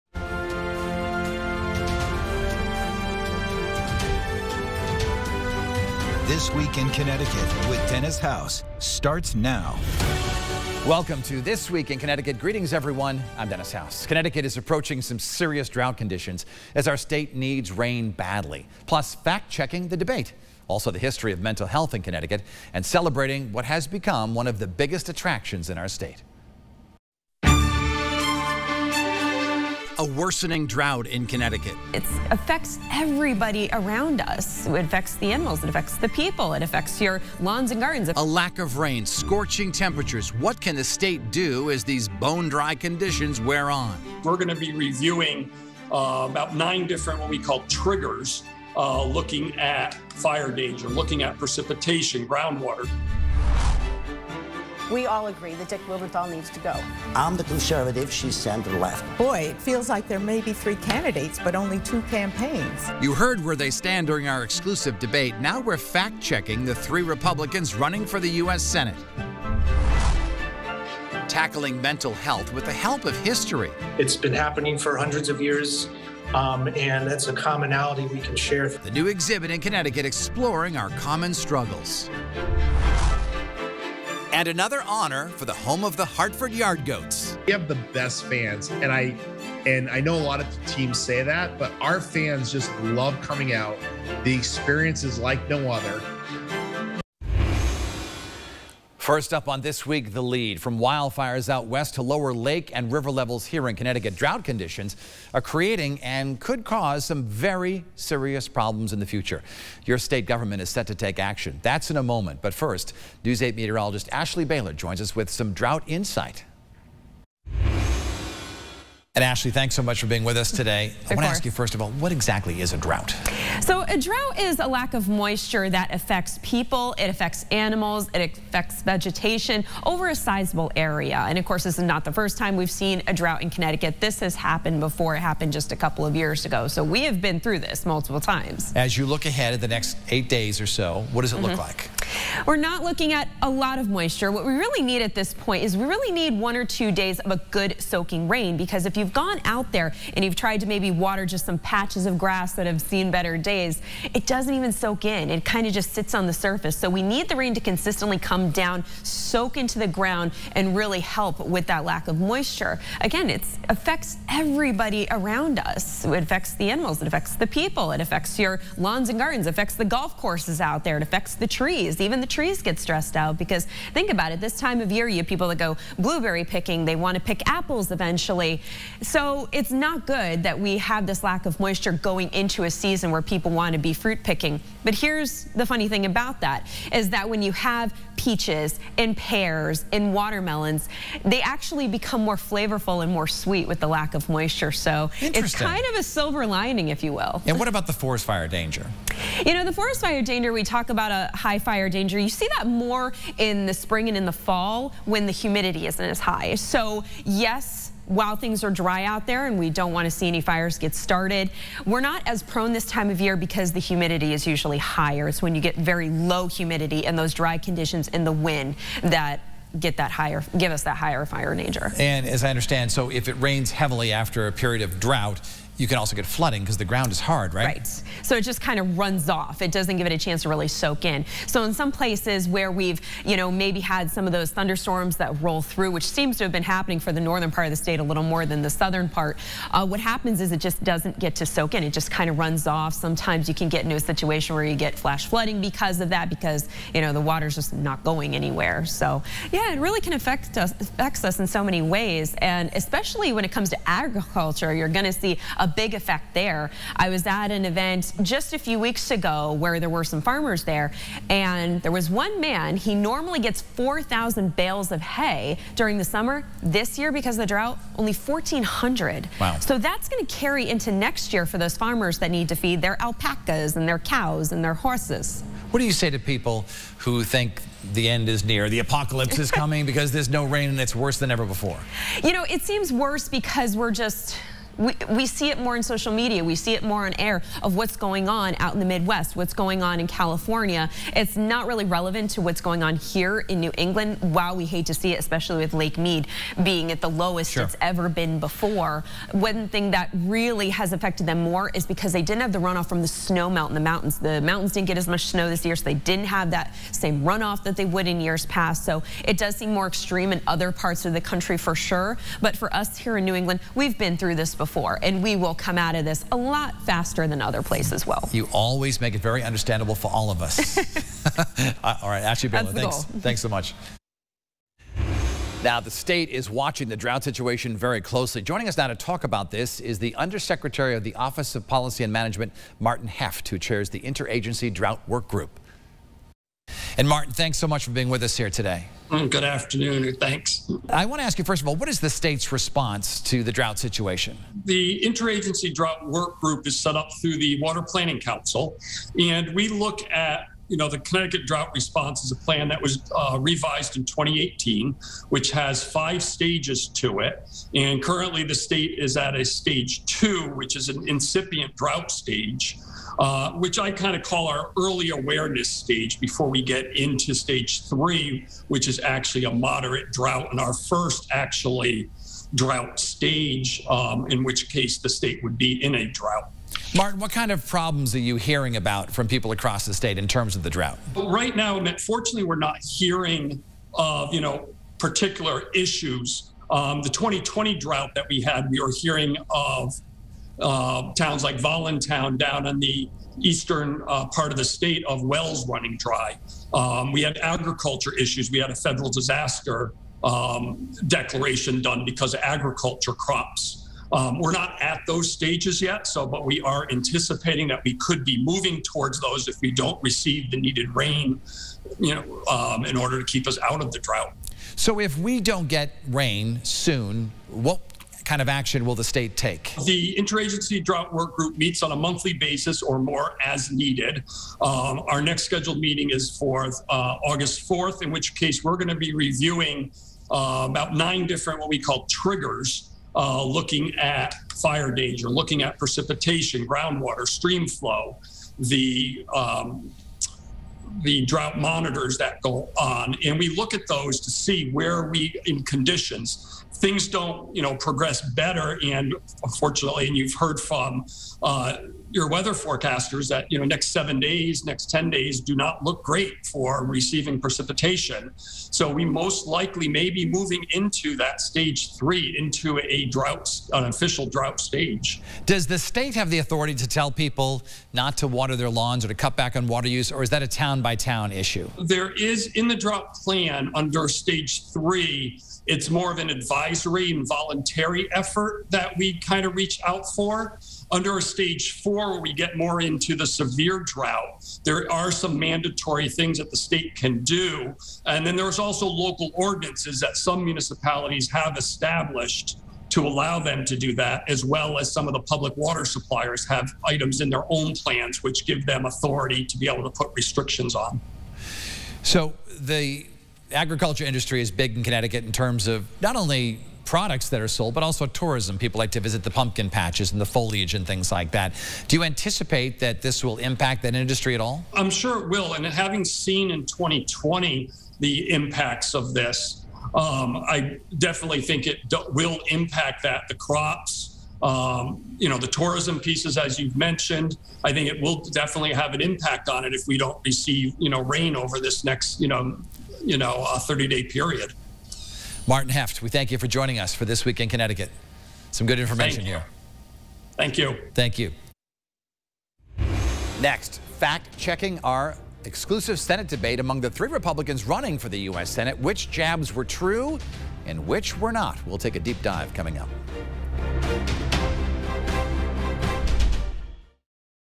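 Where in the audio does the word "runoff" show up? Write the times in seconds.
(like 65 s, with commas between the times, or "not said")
302 s, 307 s.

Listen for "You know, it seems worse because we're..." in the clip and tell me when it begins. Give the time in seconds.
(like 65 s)
282 s.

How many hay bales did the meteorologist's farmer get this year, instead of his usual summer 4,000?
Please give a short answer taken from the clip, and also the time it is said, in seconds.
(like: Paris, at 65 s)
1,400, at 268 s.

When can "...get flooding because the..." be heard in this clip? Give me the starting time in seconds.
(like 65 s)
226 s.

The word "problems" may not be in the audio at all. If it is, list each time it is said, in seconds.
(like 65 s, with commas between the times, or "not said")
108 s, 377 s.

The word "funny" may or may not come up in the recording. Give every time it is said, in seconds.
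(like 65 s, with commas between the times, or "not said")
185 s.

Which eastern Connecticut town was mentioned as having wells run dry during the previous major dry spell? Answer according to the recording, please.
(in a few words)
Voluntown.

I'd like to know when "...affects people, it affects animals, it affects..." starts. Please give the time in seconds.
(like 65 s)
125 s.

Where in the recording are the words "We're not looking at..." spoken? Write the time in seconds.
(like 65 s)
142 s.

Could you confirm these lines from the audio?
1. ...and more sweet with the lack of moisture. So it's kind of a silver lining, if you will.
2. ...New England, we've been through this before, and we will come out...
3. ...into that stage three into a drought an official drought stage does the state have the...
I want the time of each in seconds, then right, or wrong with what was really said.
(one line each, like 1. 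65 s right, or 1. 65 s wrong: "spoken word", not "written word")
1. 193 s right
2. 313 s right
3. 460 s right.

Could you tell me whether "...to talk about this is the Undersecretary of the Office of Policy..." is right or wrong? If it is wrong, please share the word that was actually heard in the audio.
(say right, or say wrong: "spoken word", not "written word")
right.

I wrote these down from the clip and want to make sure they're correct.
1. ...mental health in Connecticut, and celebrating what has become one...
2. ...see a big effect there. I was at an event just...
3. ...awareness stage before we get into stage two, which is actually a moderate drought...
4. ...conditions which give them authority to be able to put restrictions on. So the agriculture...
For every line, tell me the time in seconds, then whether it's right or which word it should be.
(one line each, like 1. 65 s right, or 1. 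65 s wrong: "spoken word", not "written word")
1. 21 s right
2. 255 s right
3. 365 s wrong: "three", not "two"
4. 497 s wrong: "plans", not "conditions".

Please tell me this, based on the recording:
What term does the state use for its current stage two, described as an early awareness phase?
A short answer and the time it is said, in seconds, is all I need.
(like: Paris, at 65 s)
incipient drought, at 361 s.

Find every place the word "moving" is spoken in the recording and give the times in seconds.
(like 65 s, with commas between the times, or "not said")
408 s, 460 s.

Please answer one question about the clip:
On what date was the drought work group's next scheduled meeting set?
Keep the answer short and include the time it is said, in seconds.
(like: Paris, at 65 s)
August 4, at 427 s.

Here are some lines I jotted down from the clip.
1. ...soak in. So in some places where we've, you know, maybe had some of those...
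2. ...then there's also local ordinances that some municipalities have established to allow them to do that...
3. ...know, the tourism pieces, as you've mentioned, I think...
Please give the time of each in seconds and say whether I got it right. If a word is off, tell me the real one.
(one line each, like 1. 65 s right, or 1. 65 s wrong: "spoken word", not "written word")
1. 230 s right
2. 488 s right
3. 525 s right.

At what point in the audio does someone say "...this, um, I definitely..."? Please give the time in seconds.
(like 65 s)
519 s.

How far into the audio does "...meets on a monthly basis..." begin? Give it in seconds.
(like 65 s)
421 s.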